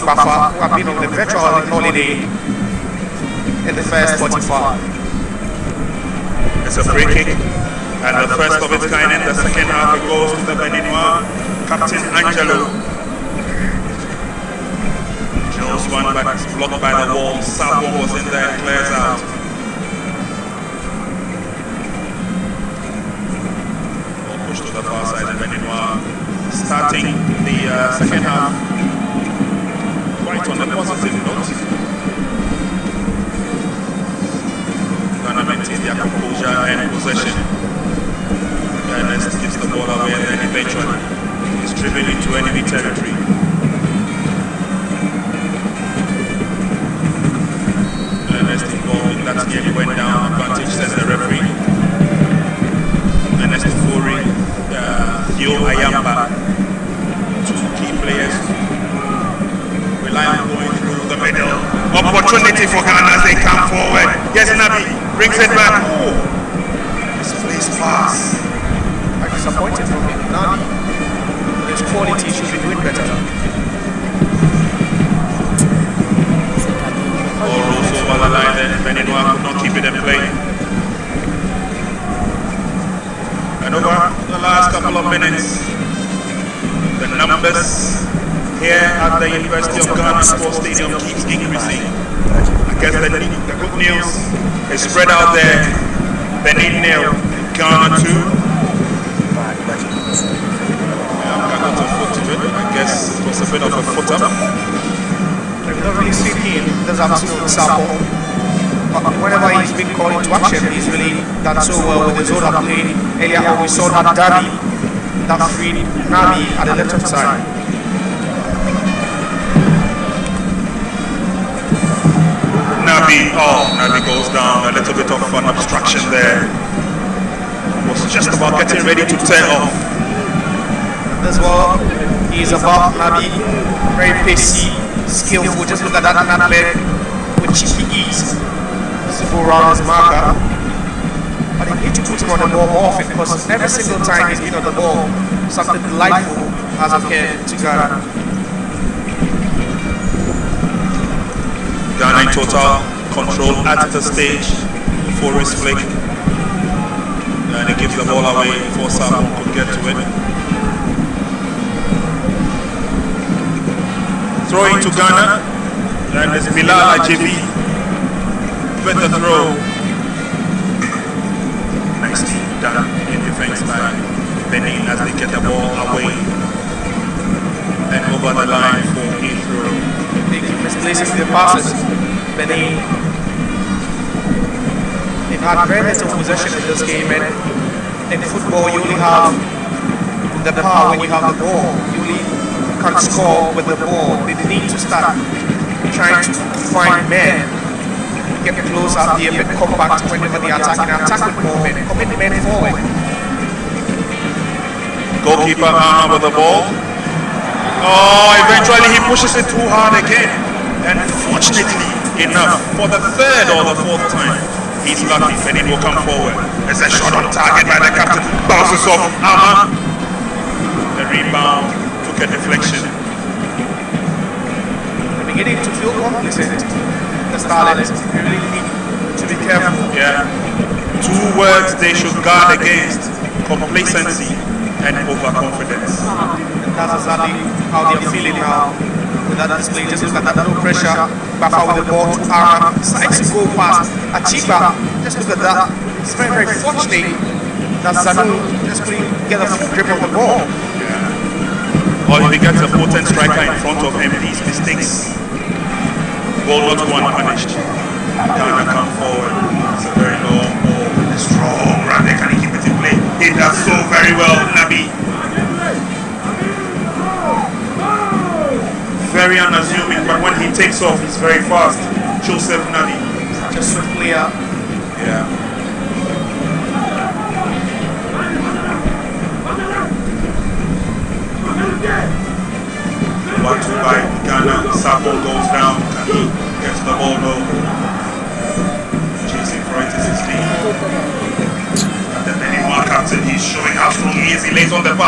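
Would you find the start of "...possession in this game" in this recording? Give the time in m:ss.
3:06.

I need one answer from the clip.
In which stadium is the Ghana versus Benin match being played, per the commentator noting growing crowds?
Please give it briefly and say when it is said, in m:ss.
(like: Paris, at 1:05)
University of Ghana Sports Stadium, at 1:29.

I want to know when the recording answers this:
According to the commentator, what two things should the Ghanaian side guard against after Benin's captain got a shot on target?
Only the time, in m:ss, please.
3:53.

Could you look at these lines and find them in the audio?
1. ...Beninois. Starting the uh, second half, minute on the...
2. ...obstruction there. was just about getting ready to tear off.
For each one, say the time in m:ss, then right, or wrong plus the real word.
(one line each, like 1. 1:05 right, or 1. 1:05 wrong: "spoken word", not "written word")
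1. 0:25 wrong: "quite", not "minute"
2. 2:05 right.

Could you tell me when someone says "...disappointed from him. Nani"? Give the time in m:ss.
1:09.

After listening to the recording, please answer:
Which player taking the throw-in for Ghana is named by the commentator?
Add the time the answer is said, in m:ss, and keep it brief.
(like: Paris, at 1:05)
Bilal Ajibi, at 2:46.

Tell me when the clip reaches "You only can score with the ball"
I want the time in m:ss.
3:11.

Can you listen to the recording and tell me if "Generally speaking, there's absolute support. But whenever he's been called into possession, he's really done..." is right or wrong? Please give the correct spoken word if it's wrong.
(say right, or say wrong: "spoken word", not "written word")
wrong: "action", not "possession".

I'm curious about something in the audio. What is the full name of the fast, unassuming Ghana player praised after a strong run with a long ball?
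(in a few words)
Joseph Nani.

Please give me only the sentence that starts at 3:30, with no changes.
And fortunately enough, for the third or the fourth time, He's not defending.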